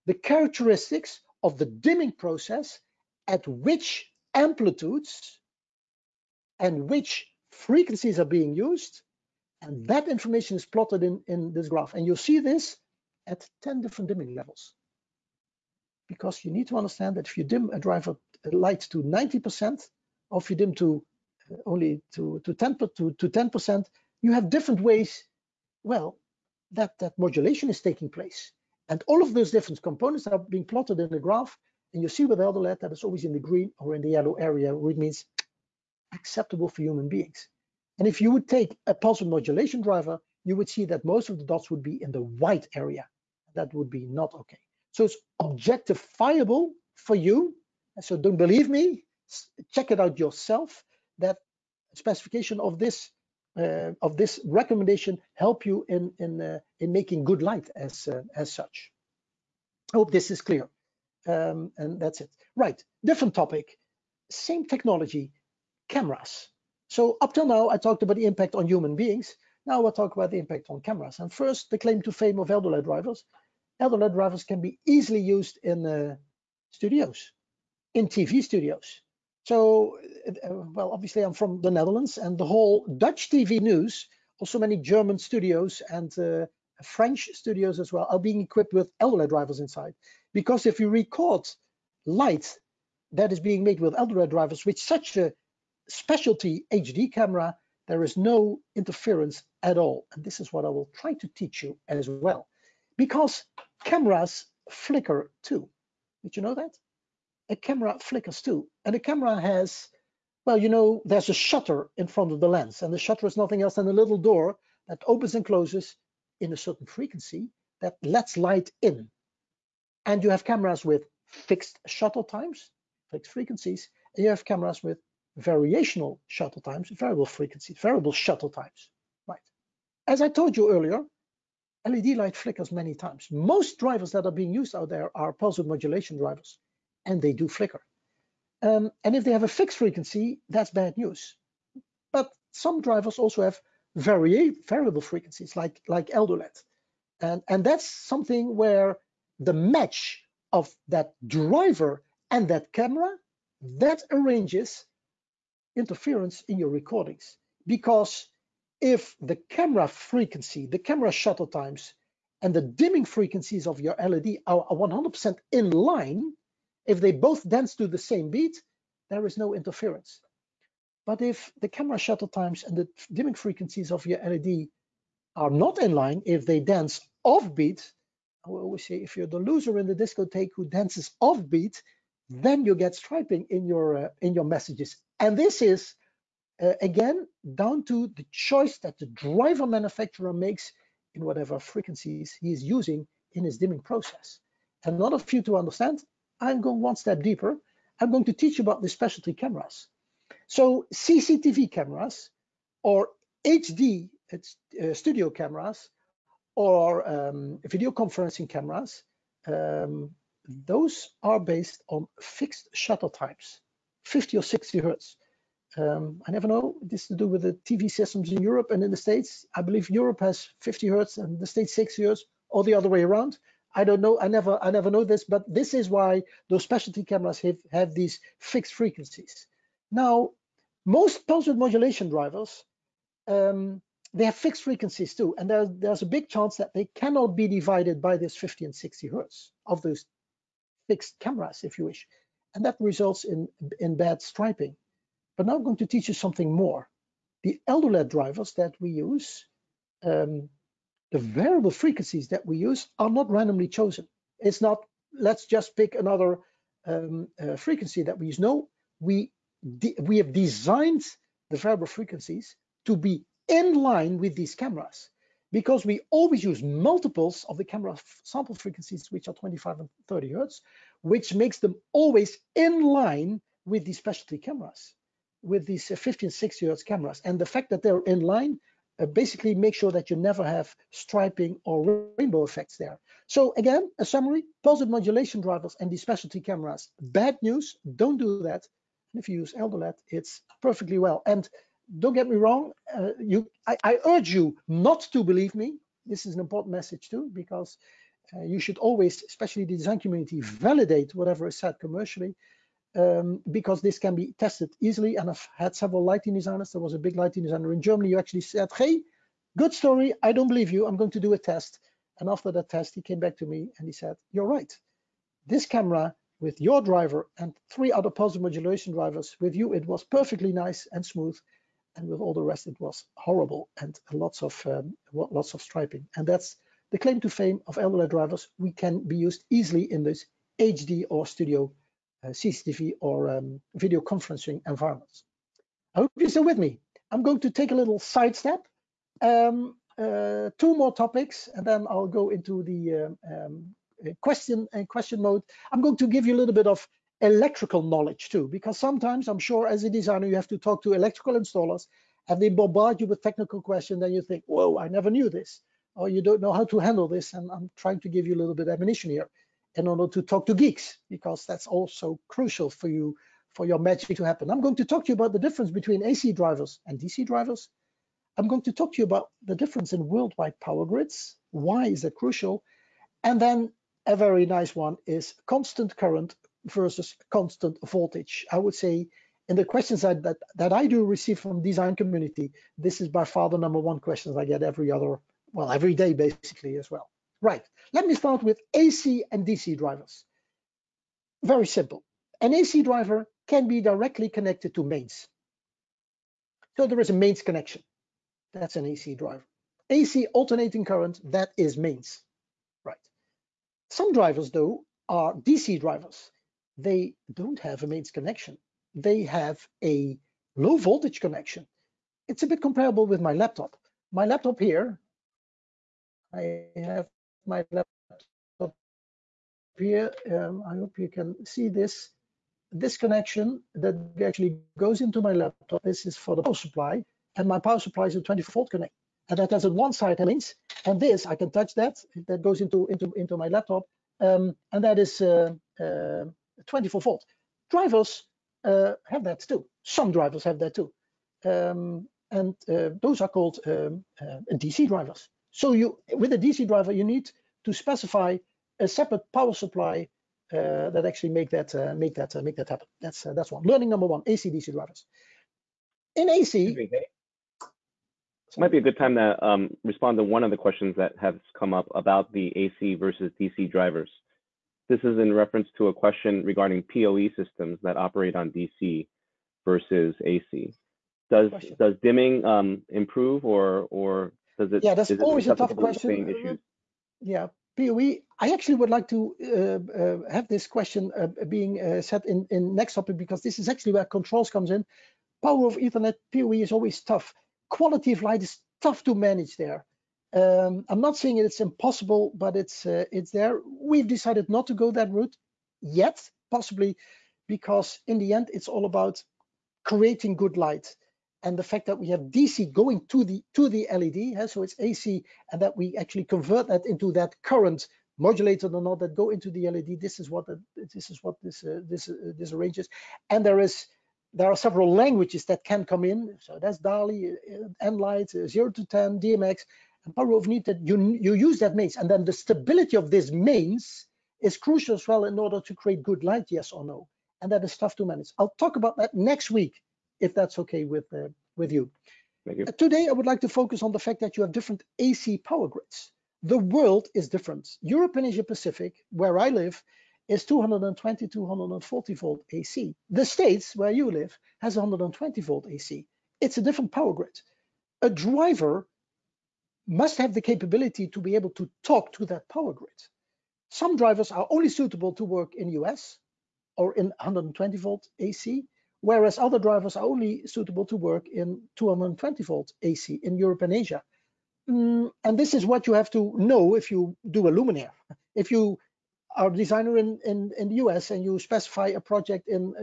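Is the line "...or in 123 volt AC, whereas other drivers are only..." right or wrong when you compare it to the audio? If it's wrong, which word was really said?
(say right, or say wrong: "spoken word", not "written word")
wrong: "120", not "123".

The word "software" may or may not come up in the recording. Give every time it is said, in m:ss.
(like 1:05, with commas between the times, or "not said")
not said.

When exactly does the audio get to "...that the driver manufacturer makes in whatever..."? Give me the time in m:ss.
3:08.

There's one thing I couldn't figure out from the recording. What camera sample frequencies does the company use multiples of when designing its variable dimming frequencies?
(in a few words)
25 and 30 hertz.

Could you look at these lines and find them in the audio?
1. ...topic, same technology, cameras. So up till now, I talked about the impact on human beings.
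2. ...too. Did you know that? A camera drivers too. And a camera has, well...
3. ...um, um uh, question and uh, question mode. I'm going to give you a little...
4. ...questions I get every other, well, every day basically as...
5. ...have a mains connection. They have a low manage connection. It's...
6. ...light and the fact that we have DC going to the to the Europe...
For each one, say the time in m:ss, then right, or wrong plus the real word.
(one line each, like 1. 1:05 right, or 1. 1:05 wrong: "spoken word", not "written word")
1. 1:03 right
2. 1:45 wrong: "flickers", not "drivers"
3. 5:43 right
4. 6:23 right
5. 6:47 wrong: "voltage", not "manage"
6. 8:20 wrong: "LED", not "Europe".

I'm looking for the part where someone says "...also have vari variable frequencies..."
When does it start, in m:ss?
2:23.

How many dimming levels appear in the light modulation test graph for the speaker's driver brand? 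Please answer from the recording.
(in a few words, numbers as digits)
10.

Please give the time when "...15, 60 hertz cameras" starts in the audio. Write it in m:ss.
4:35.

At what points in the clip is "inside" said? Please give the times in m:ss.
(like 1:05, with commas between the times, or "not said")
1:29.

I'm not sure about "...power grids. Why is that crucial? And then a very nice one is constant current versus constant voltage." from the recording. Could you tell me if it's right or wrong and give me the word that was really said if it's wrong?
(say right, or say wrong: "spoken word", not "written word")
right.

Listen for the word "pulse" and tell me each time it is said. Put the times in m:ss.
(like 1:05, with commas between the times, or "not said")
0:38, 2:15, 3:51, 4:44, 5:18.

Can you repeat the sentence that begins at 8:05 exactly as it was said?
Power over Ethernet PoE is always tough.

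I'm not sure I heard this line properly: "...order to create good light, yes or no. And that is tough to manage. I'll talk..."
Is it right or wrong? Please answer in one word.
right.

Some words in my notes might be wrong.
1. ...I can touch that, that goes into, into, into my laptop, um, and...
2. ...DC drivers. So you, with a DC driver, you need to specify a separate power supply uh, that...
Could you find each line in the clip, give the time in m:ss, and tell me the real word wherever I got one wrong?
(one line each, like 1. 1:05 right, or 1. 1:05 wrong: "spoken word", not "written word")
1. 7:11 right
2. 7:24 right.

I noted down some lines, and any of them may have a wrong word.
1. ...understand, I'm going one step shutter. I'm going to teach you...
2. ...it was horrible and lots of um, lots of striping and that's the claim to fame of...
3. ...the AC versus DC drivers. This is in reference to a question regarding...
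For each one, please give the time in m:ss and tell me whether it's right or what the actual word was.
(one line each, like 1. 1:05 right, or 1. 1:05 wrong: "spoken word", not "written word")
1. 3:15 wrong: "deeper", not "shutter"
2. 5:22 right
3. 7:42 right.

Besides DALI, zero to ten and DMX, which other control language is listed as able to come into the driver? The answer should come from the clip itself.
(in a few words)
nLight.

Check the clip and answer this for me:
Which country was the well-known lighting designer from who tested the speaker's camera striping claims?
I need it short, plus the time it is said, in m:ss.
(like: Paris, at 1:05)
Germany, at 5:07.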